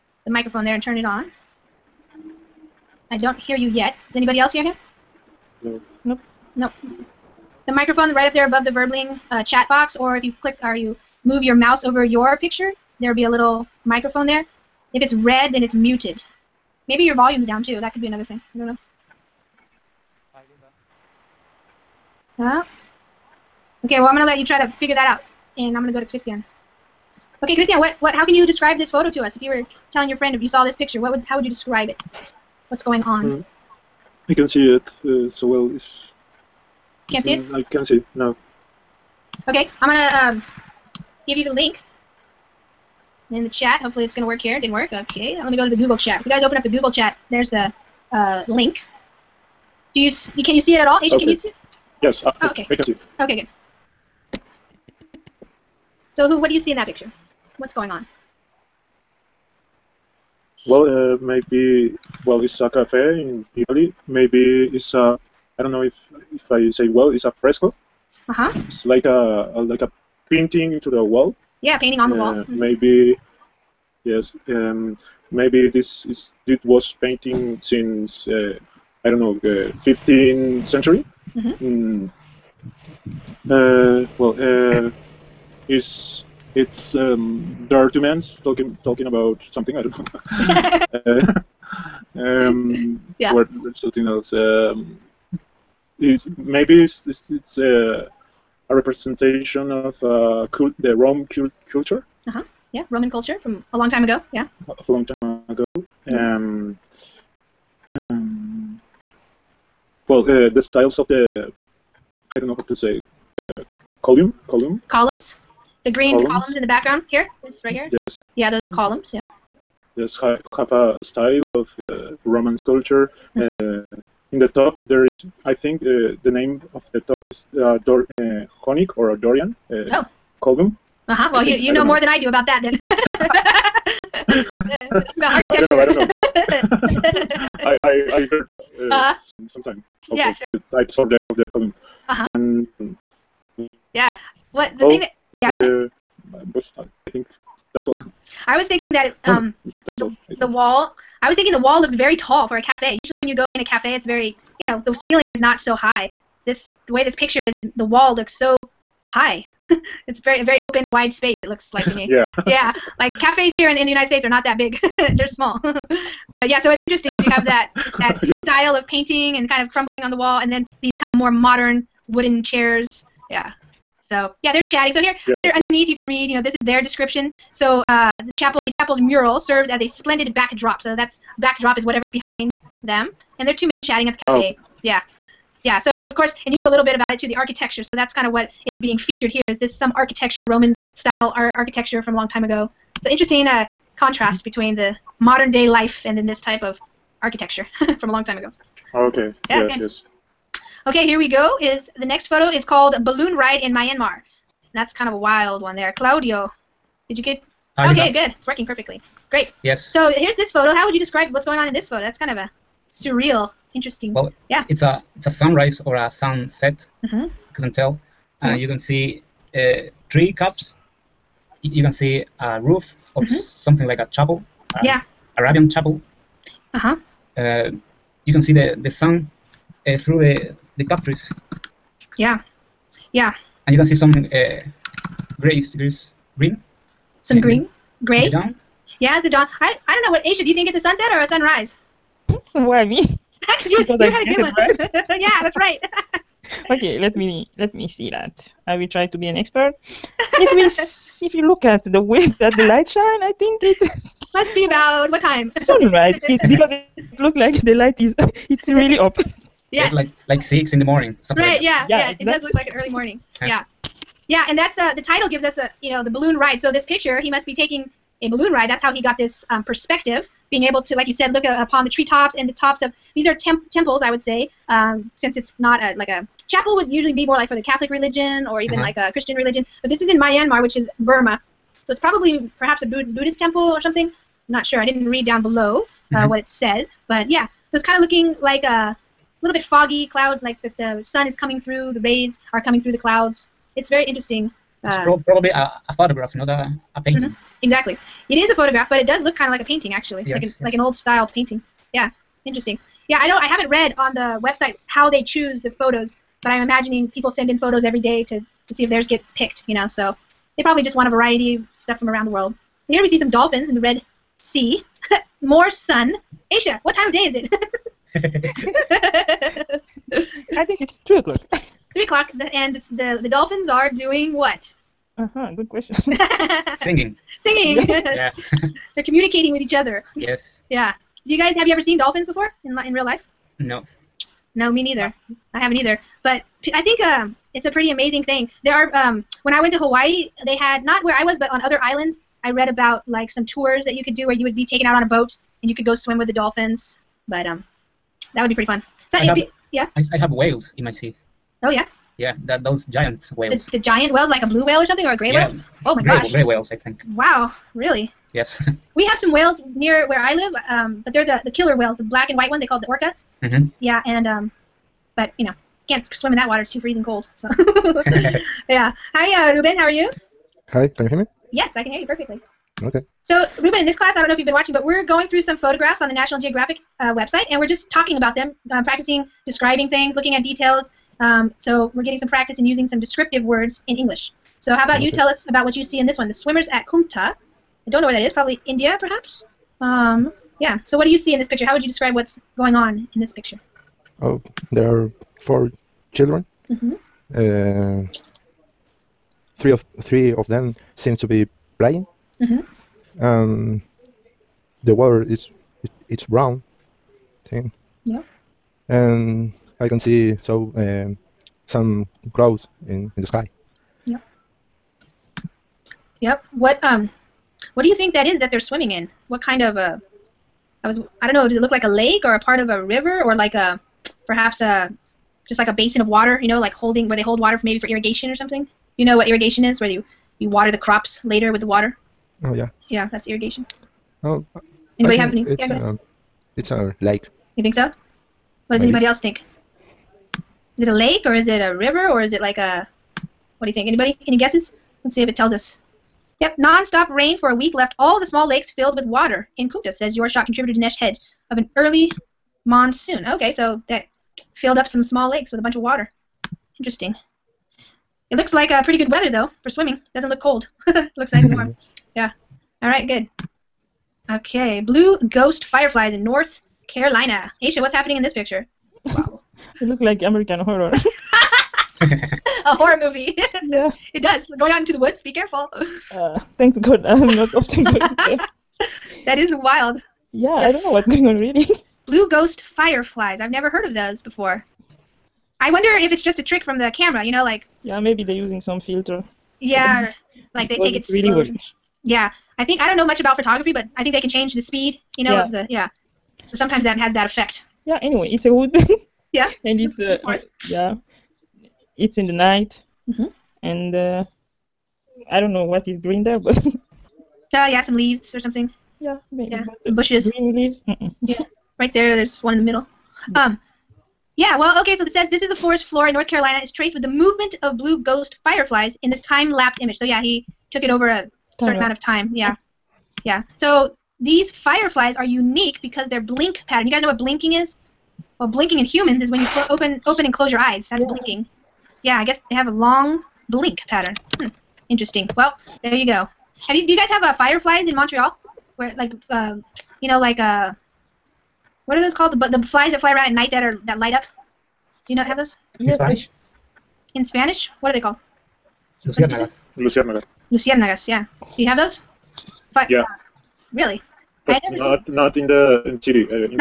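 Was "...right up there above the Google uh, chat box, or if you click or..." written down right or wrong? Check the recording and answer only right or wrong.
wrong.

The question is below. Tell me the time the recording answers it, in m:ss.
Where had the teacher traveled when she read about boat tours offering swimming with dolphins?
5:39.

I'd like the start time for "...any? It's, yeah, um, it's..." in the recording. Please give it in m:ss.
7:15.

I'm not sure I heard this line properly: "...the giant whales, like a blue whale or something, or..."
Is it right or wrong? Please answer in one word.
right.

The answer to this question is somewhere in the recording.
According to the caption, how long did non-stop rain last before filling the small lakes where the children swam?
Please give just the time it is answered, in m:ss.
7:27.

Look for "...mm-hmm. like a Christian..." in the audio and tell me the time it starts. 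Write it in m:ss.
4:38.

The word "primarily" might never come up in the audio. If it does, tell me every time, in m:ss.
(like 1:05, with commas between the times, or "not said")
not said.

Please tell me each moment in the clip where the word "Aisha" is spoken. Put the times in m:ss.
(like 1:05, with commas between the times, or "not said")
0:50, 4:00, 5:16, 7:47.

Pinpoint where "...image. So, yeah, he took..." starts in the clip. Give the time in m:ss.
8:39.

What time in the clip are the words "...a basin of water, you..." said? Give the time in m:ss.
7:05.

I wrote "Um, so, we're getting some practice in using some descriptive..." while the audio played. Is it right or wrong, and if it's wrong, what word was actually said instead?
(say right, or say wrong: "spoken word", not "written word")
right.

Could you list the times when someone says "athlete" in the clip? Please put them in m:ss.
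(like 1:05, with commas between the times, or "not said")
not said.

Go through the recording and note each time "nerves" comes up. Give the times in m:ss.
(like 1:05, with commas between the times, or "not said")
not said.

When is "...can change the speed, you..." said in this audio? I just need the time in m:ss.
8:14.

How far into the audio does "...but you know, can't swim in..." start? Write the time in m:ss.
6:05.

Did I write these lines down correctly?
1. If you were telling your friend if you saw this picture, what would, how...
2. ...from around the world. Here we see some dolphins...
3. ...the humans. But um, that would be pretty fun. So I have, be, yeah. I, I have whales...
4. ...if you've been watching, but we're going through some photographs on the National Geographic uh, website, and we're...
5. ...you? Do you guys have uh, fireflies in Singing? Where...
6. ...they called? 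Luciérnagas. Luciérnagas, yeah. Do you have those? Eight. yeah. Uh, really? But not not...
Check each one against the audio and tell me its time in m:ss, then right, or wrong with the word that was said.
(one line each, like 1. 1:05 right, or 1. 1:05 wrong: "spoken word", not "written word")
1. 0:29 right
2. 5:11 right
3. 5:46 wrong: "dolphins", not "humans"
4. 6:14 right
5. 8:56 wrong: "Montreal", not "Singing"
6. 9:07 wrong: "Five", not "Eight".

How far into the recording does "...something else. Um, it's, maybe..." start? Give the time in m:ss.
1:33.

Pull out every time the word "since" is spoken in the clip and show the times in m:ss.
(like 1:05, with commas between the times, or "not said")
1:17, 4:35.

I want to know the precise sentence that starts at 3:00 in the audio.
So that's backdrop is whatever's behind them and they're two men chatting at the cafe.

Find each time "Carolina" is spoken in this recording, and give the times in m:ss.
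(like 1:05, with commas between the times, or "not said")
7:46, 8:36.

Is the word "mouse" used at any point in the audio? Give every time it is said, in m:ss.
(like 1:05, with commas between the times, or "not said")
0:11.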